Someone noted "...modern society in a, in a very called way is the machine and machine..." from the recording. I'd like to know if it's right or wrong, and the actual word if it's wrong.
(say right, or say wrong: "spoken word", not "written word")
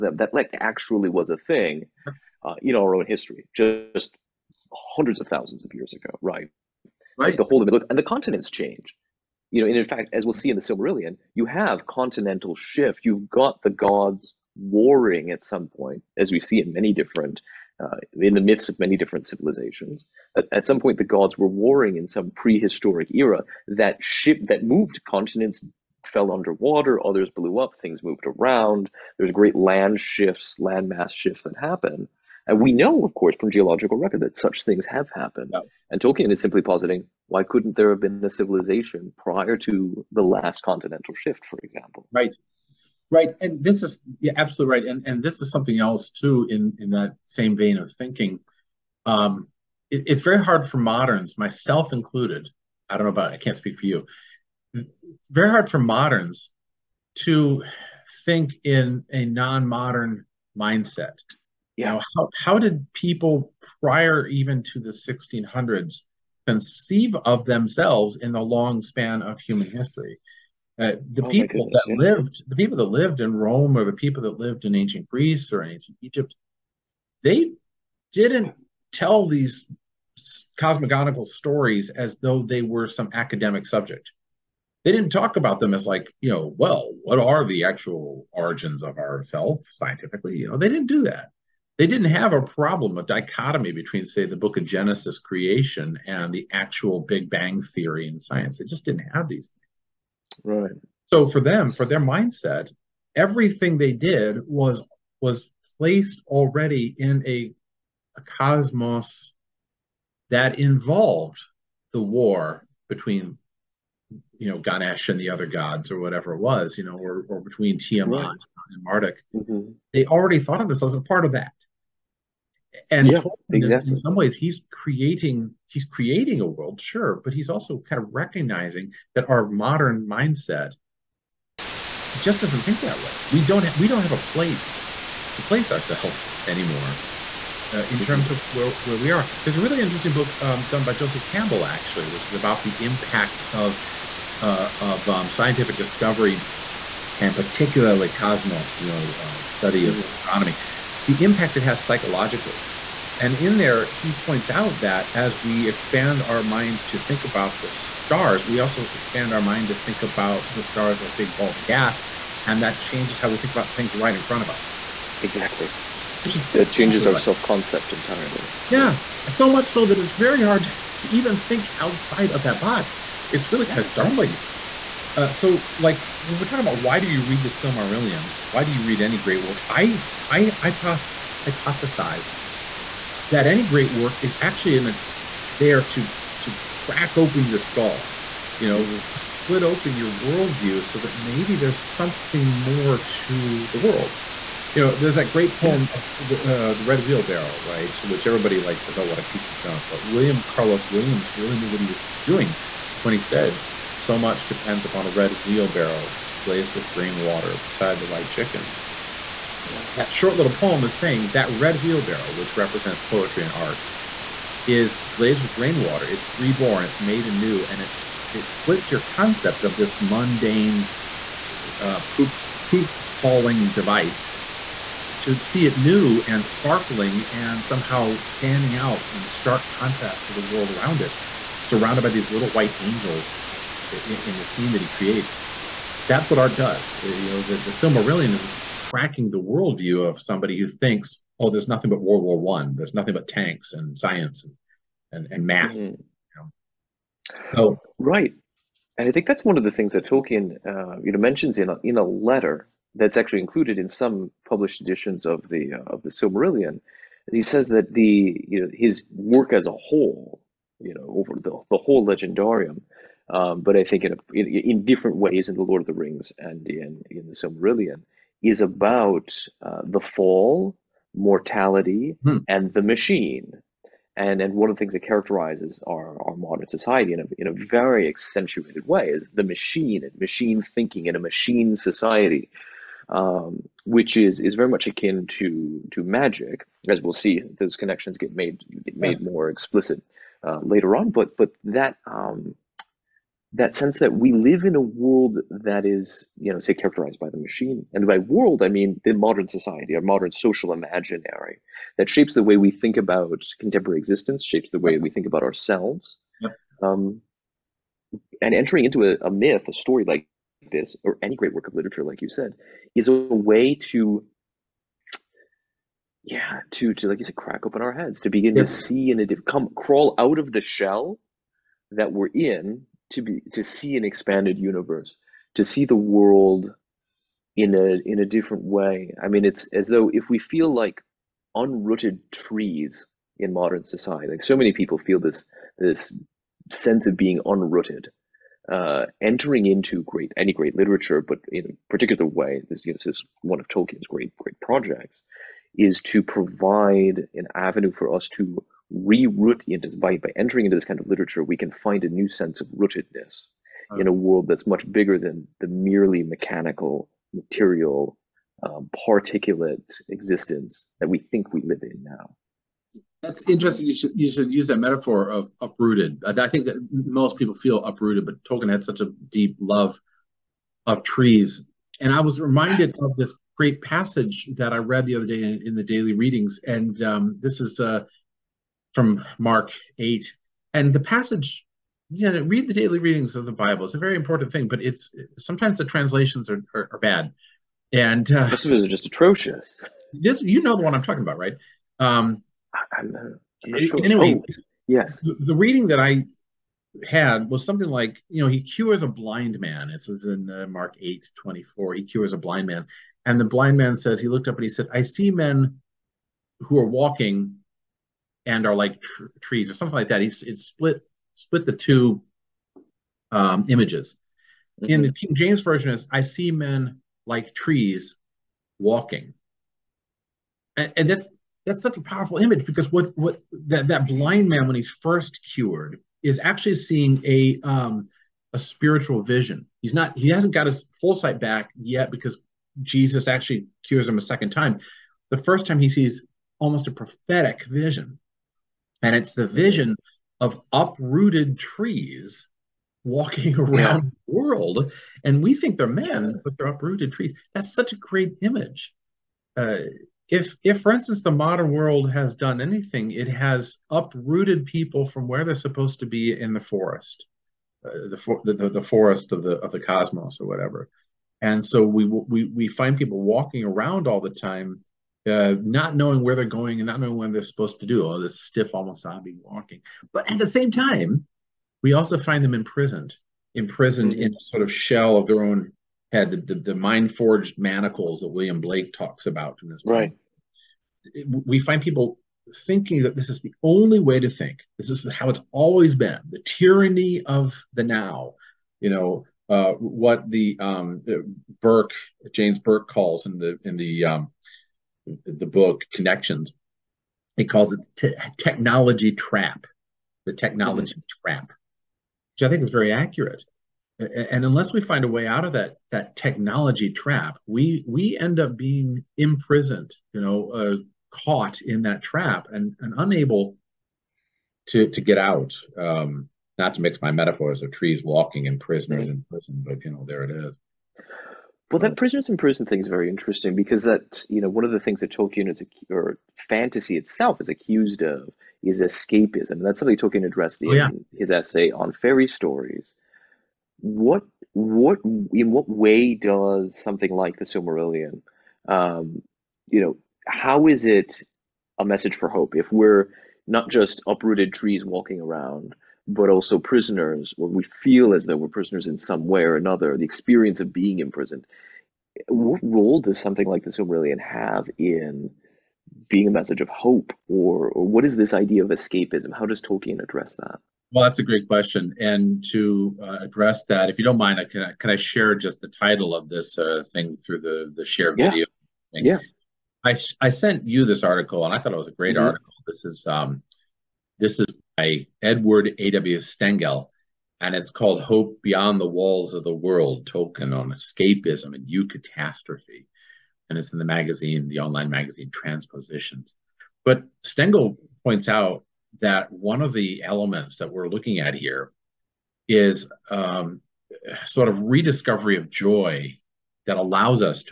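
wrong: "accentuated", not "called".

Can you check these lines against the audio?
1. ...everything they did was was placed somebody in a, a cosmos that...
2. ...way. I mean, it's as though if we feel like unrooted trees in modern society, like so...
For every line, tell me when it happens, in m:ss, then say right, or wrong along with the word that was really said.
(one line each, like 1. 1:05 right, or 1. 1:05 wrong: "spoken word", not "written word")
1. 1:43 wrong: "already", not "somebody"
2. 5:28 right.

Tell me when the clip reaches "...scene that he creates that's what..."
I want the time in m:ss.
3:54.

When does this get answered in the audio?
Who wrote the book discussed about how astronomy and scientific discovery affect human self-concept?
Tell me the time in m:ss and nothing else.
2:20.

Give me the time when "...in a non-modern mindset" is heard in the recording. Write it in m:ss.
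0:58.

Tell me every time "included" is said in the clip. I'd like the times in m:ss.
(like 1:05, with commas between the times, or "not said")
0:51, 4:13.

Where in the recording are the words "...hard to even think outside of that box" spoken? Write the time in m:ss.
2:50.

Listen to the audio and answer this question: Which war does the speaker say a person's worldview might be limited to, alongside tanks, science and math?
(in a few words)
World War One.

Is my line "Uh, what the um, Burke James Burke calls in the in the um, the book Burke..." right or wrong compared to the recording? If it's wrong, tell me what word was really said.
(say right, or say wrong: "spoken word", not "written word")
wrong: "Connections", not "Burke".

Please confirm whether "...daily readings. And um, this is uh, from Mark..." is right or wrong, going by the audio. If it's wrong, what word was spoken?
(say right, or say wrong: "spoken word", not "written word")
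right.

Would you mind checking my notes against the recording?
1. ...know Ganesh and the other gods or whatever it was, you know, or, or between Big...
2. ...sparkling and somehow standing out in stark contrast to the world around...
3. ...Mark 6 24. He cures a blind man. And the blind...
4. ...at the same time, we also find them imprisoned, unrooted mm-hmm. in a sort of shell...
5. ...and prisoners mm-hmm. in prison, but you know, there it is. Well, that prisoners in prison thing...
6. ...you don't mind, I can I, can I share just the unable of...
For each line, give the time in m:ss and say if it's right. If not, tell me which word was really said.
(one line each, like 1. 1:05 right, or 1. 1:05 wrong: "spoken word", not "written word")
1. 1:54 wrong: "Tiamat", not "Big"
2. 3:46 right
3. 6:40 wrong: "8", not "6"
4. 7:50 wrong: "imprisoned", not "unrooted"
5. 8:38 right
6. 9:23 wrong: "title", not "unable".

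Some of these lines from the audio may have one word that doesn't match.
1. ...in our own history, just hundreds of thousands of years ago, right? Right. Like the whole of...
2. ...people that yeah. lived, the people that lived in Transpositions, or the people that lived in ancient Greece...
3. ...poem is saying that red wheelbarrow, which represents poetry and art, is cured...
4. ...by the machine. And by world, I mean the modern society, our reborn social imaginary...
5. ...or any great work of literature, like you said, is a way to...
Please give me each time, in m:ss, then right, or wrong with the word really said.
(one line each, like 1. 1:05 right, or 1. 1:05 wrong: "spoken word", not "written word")
1. 0:02 right
2. 1:11 wrong: "Rome", not "Transpositions"
3. 3:30 wrong: "glazed", not "cured"
4. 4:57 wrong: "modern", not "reborn"
5. 5:11 right.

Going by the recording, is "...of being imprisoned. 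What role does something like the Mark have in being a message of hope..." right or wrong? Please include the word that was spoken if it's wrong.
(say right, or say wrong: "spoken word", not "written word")
wrong: "Silmarillion", not "Mark".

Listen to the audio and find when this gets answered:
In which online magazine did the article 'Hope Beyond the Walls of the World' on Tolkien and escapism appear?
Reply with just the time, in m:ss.
9:45.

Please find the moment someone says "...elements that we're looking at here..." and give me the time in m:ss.
9:50.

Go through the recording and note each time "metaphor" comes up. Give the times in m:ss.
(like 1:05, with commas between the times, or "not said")
6:04, 8:37.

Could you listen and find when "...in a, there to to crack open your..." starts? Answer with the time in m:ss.
3:04.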